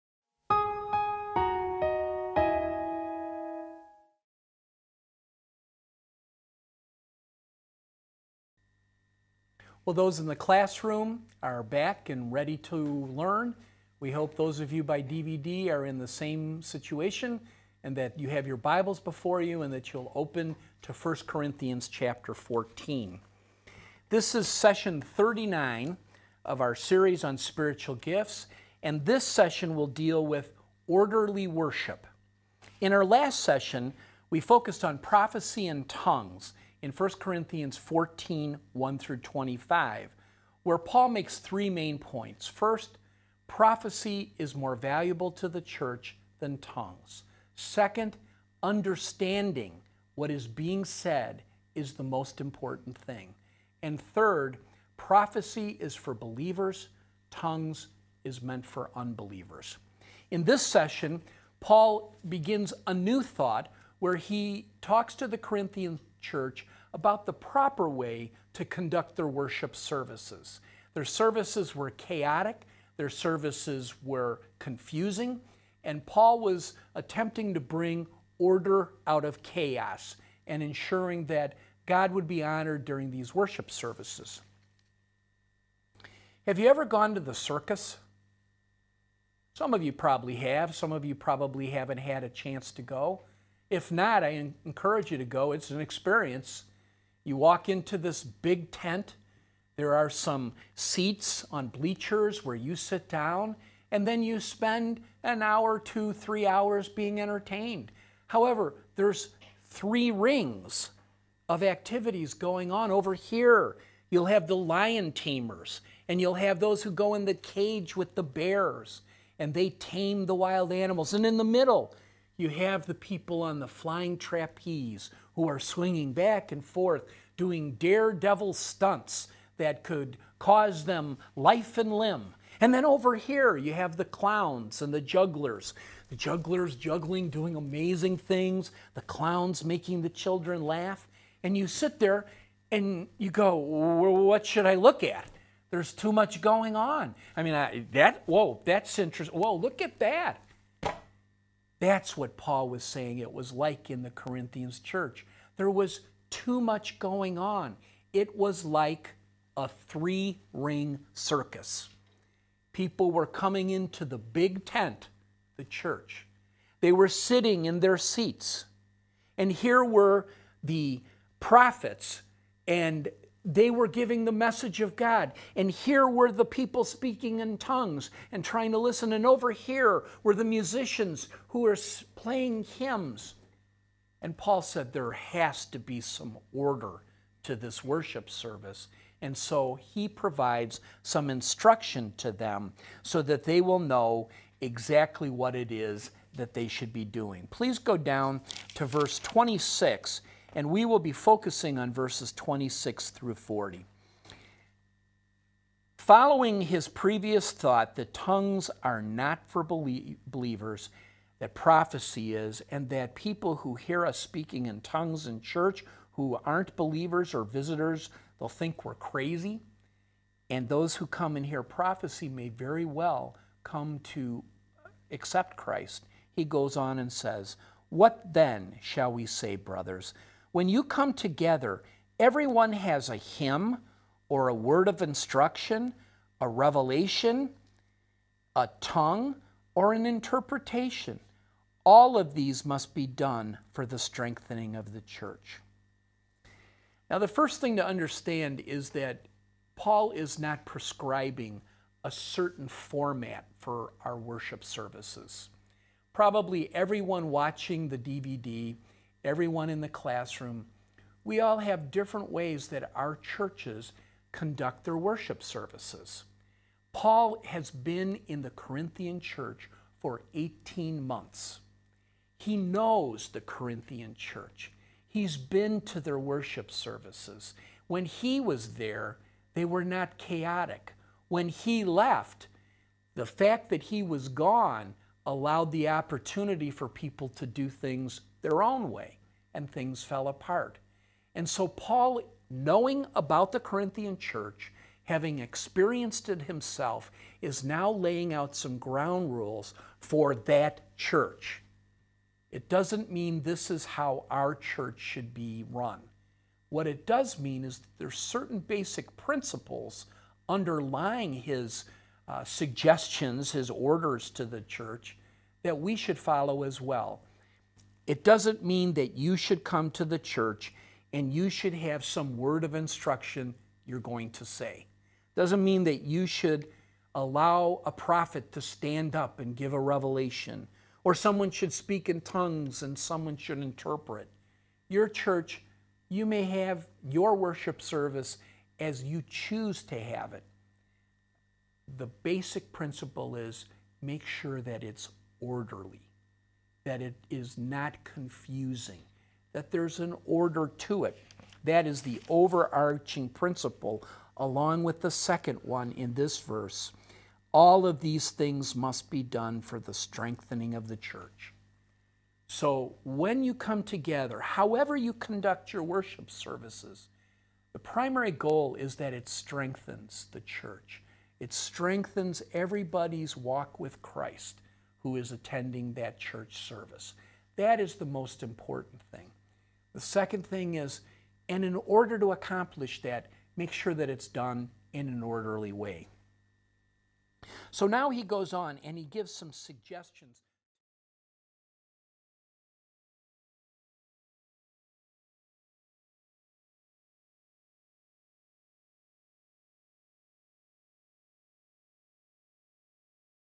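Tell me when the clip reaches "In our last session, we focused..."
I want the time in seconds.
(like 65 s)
32 s.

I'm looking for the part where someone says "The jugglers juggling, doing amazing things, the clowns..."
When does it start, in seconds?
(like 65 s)
136 s.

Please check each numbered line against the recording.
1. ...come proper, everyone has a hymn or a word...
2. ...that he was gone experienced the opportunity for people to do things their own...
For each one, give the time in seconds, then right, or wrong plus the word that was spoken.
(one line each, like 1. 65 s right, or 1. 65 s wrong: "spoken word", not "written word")
1. 230 s wrong: "together", not "proper"
2. 283 s wrong: "allowed", not "experienced".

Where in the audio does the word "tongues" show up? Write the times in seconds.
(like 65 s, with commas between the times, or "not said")
35 s, 46 s, 57 s, 177 s, 208 s, 214 s, 238 s, 332 s.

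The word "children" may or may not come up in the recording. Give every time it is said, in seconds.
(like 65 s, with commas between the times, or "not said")
140 s.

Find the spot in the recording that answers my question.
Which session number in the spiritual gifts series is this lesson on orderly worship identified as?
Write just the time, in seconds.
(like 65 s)
24 s.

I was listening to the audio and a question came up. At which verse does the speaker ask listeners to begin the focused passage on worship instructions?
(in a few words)
Verse 26.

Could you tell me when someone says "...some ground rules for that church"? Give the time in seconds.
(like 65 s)
298 s.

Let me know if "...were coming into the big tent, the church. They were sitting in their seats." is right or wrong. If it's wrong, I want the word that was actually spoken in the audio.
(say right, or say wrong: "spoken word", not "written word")
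right.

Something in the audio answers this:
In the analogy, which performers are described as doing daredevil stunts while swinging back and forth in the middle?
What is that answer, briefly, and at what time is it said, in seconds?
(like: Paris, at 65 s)
Flying trapeze, at 123 s.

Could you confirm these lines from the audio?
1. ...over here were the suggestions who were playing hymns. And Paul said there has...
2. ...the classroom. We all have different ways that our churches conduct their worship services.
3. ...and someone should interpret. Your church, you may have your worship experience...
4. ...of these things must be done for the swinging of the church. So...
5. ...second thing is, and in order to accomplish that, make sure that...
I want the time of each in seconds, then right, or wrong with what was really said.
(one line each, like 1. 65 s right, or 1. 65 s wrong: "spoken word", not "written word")
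1. 179 s wrong: "musicians", not "suggestions"
2. 259 s right
3. 332 s wrong: "service", not "experience"
4. 357 s wrong: "strengthening", not "swinging"
5. 379 s right.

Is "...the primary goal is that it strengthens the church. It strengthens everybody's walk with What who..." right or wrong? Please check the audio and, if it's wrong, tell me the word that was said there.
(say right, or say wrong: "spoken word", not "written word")
wrong: "Christ", not "What".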